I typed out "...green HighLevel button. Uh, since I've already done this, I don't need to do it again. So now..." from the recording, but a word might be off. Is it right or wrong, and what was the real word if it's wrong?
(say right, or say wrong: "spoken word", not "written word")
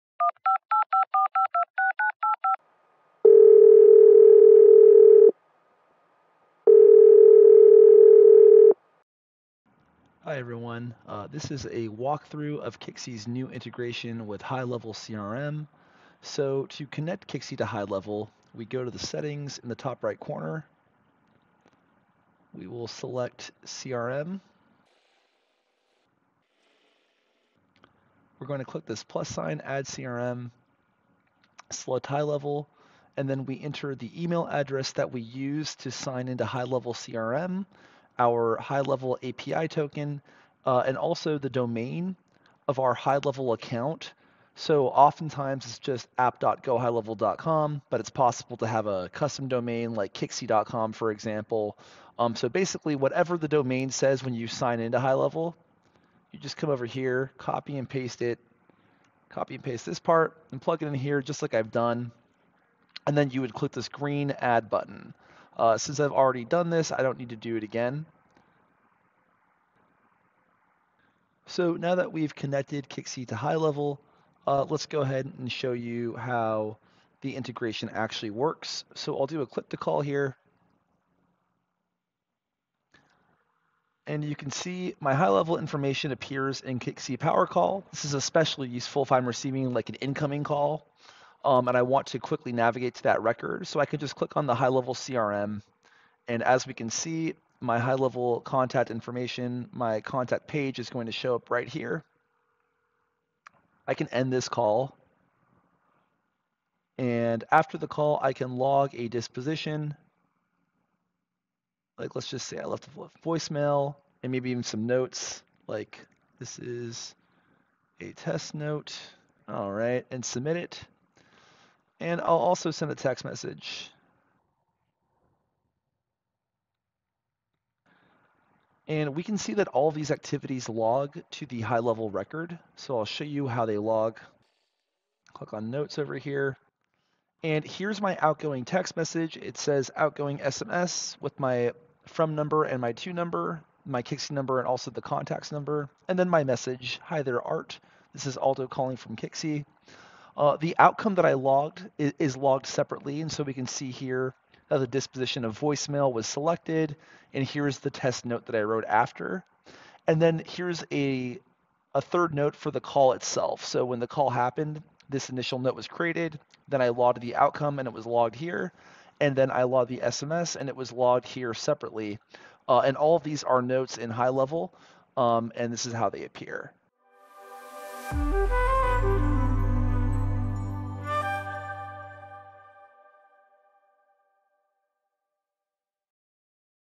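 wrong: "Add", not "HighLevel".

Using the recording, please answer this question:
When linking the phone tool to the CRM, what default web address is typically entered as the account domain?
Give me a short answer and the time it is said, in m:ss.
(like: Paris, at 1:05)
app.gohighlevel.com, at 0:46.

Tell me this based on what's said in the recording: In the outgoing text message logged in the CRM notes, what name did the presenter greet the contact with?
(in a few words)
Art.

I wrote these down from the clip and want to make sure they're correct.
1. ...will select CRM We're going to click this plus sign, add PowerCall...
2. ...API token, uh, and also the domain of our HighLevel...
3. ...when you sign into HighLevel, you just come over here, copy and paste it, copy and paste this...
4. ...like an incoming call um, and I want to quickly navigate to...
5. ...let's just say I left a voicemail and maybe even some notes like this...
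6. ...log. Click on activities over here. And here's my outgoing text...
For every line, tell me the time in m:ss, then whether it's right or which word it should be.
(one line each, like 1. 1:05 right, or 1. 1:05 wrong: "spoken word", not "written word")
1. 0:22 wrong: "CRM", not "PowerCall"
2. 0:39 right
3. 0:54 right
4. 1:29 right
5. 1:52 right
6. 2:13 wrong: "notes", not "activities".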